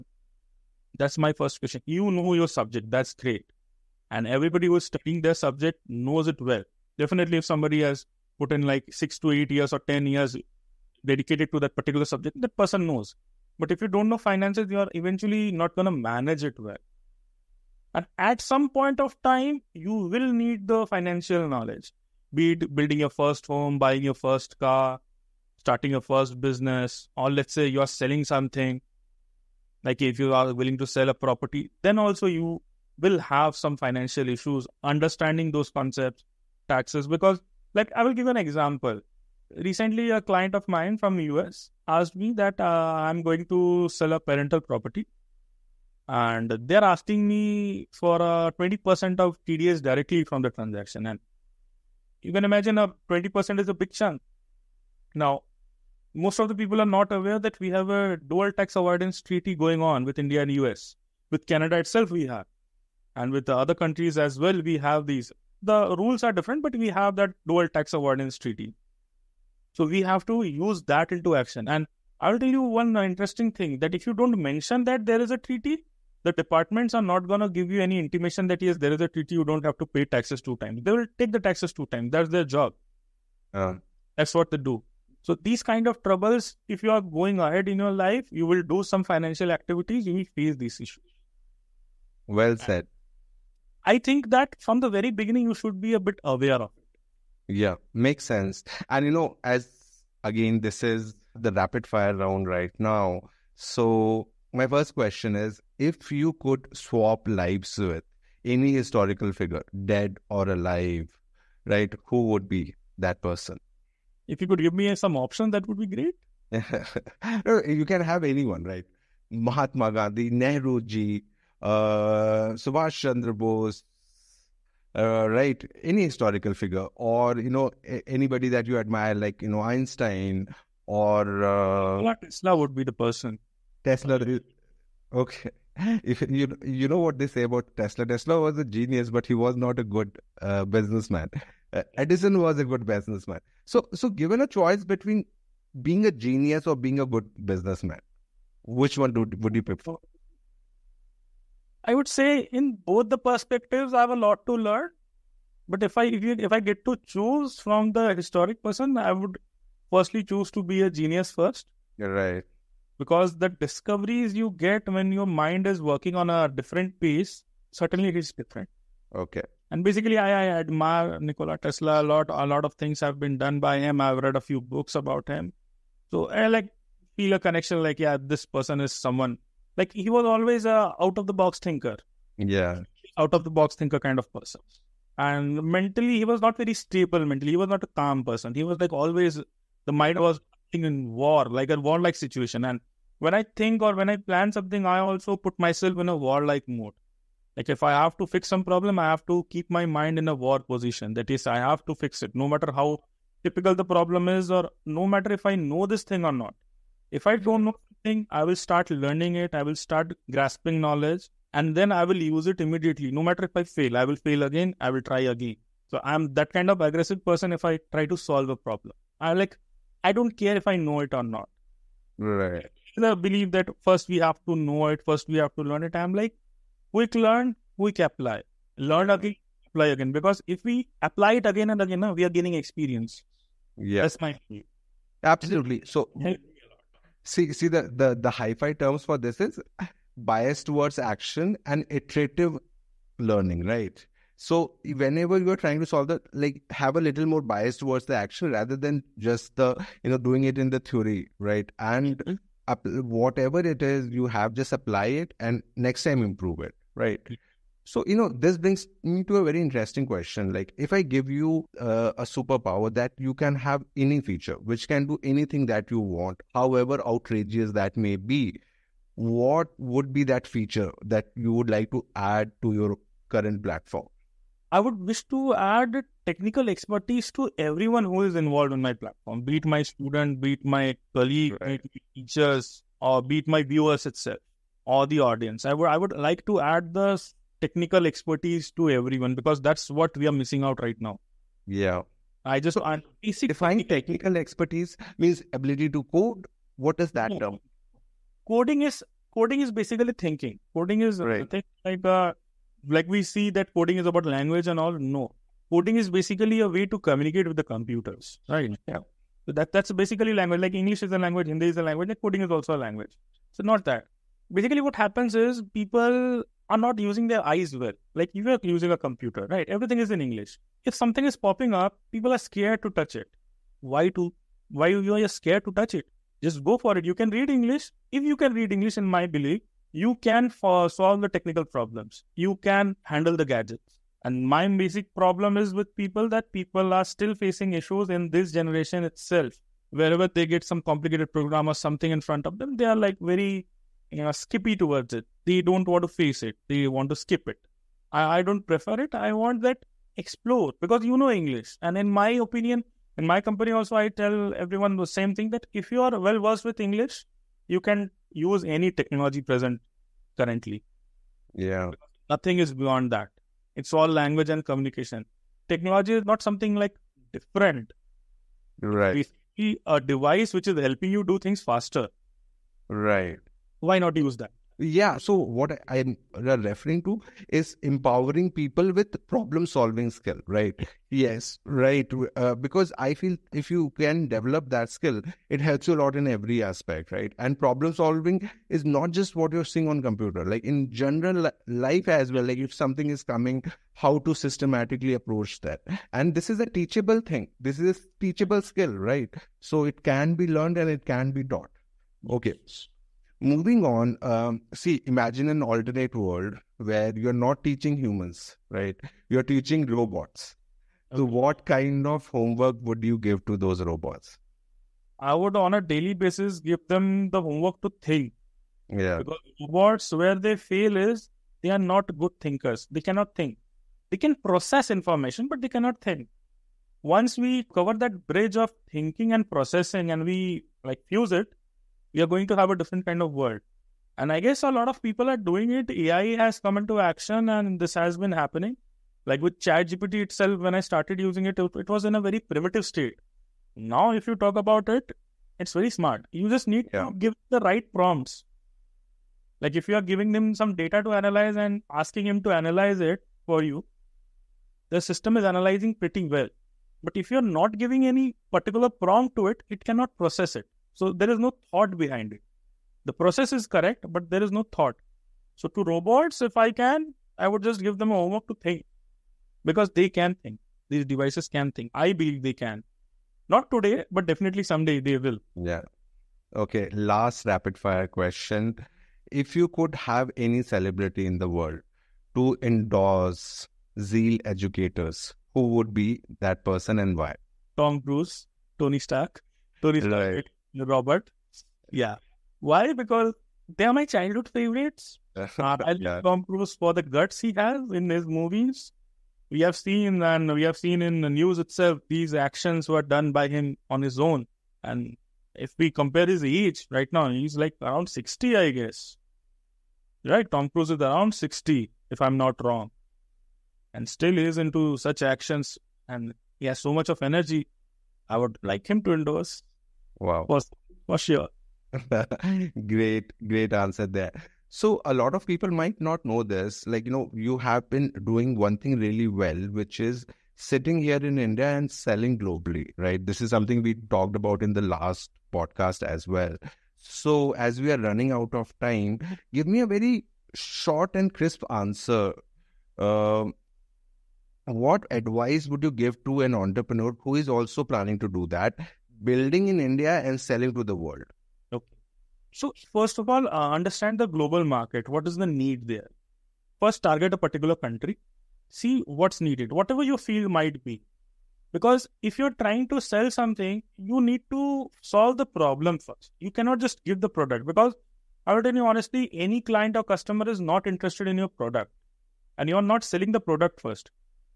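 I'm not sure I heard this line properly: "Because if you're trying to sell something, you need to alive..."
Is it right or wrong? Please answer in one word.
wrong.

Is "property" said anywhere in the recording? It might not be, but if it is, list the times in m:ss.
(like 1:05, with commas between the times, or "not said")
0:31, 0:44.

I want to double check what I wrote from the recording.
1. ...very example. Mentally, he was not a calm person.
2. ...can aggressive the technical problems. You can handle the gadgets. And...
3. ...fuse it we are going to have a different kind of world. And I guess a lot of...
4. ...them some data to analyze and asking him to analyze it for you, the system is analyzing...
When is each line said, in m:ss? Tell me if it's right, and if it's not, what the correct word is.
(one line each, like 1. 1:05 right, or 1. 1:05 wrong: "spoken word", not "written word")
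1. 3:06 wrong: "stable", not "example"
2. 5:30 wrong: "solve", not "aggressive"
3. 7:11 right
4. 7:30 right.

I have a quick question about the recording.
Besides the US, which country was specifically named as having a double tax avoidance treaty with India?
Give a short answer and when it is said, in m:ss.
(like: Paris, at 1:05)
Canada, at 1:01.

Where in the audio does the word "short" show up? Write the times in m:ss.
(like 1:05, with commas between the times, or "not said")
9:00.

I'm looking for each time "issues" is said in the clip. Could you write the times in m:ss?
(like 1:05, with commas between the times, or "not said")
0:34, 1:30, 5:37.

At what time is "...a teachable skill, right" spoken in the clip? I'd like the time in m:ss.
6:37.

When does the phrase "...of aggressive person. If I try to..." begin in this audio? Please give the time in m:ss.
3:36.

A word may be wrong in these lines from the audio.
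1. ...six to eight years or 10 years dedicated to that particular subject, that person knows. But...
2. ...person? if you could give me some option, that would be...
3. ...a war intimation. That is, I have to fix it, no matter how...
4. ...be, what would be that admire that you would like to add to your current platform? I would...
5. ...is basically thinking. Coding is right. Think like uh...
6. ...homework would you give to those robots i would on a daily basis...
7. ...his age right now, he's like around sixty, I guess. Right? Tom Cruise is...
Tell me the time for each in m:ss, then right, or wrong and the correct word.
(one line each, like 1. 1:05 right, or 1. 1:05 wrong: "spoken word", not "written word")
1. 0:08 right
2. 1:53 right
3. 3:20 wrong: "position", not "intimation"
4. 4:28 wrong: "feature", not "admire"
5. 4:59 right
6. 6:52 right
7. 8:26 right.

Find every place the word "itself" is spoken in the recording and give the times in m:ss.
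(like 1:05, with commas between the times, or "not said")
1:01, 4:44, 5:39, 7:20, 8:21.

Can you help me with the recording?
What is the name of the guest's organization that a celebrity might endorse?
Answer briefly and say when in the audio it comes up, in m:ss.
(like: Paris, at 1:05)
Zeal Educators, at 8:03.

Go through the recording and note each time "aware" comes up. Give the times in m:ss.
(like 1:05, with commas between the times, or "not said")
0:57, 1:36.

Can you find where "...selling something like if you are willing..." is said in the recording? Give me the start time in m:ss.
0:27.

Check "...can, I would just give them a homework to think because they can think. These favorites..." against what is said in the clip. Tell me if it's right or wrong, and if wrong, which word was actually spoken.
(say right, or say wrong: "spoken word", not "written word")
wrong: "devices", not "favorites".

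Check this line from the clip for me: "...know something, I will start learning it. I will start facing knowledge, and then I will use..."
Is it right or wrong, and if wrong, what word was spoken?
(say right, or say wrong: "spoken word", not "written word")
wrong: "grasping", not "facing".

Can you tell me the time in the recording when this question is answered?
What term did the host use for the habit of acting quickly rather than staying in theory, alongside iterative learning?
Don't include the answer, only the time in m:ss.
4:00.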